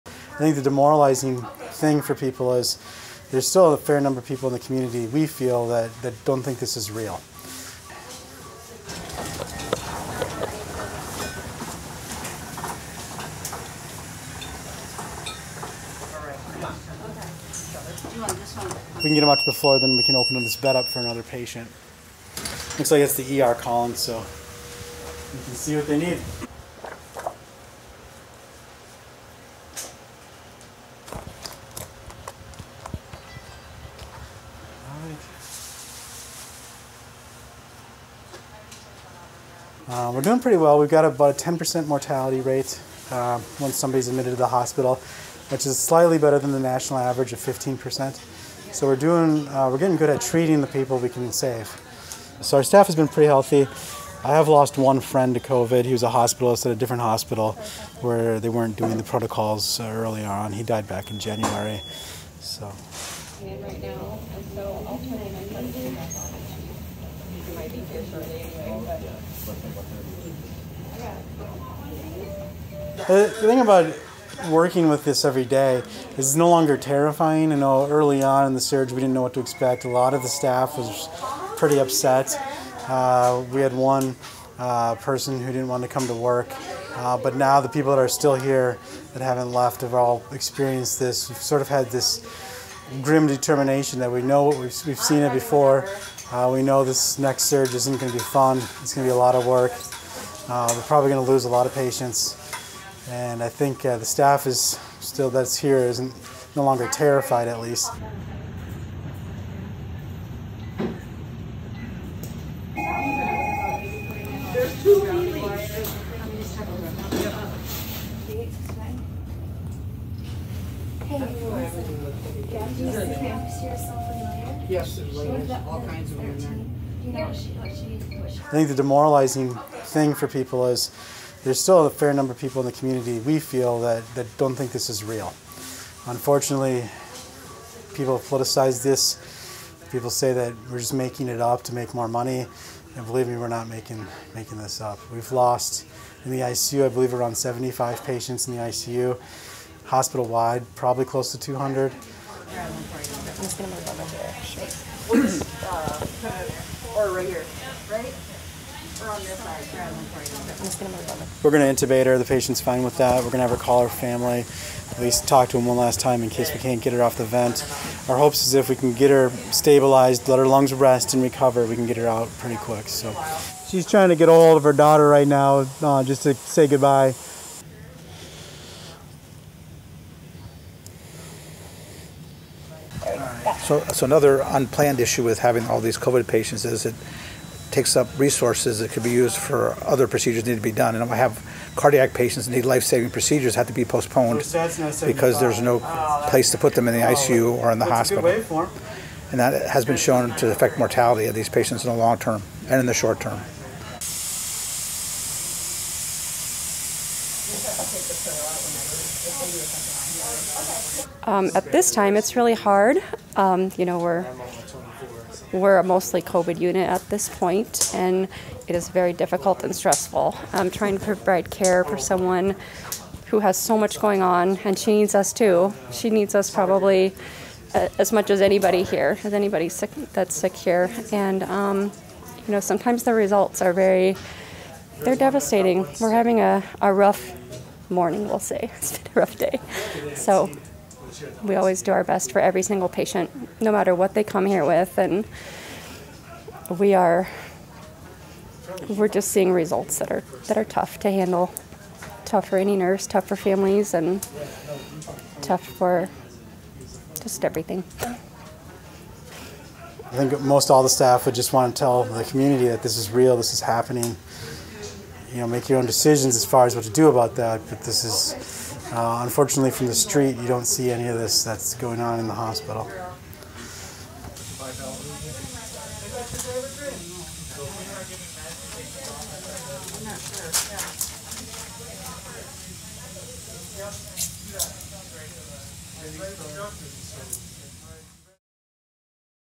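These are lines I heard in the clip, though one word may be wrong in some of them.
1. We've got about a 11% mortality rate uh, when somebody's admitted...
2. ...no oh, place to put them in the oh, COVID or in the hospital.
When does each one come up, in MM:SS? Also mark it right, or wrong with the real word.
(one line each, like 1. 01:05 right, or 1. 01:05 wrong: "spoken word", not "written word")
1. 00:40 wrong: "10", not "11"
2. 03:15 wrong: "ICU", not "COVID".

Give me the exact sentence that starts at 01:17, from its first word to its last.
I know early on in the surge, we didn't know what to expect.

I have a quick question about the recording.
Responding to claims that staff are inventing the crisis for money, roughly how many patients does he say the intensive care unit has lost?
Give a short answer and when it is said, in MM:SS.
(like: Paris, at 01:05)
75, at 02:27.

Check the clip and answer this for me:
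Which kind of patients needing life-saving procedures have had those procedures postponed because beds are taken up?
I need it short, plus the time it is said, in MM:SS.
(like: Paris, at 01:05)
Cardiac patients, at 03:11.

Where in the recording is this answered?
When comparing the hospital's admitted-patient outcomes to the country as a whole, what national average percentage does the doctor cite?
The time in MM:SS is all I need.
00:47.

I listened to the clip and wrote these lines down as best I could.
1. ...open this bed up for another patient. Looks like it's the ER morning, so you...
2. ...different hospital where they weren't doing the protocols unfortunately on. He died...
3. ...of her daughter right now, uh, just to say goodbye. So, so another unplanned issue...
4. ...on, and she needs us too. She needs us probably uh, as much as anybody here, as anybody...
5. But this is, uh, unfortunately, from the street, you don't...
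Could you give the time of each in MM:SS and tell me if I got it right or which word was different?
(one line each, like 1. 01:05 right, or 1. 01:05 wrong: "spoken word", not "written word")
1. 00:20 wrong: "calling", not "morning"
2. 00:56 wrong: "early", not "unfortunately"
3. 02:54 right
4. 03:44 right
5. 04:27 right.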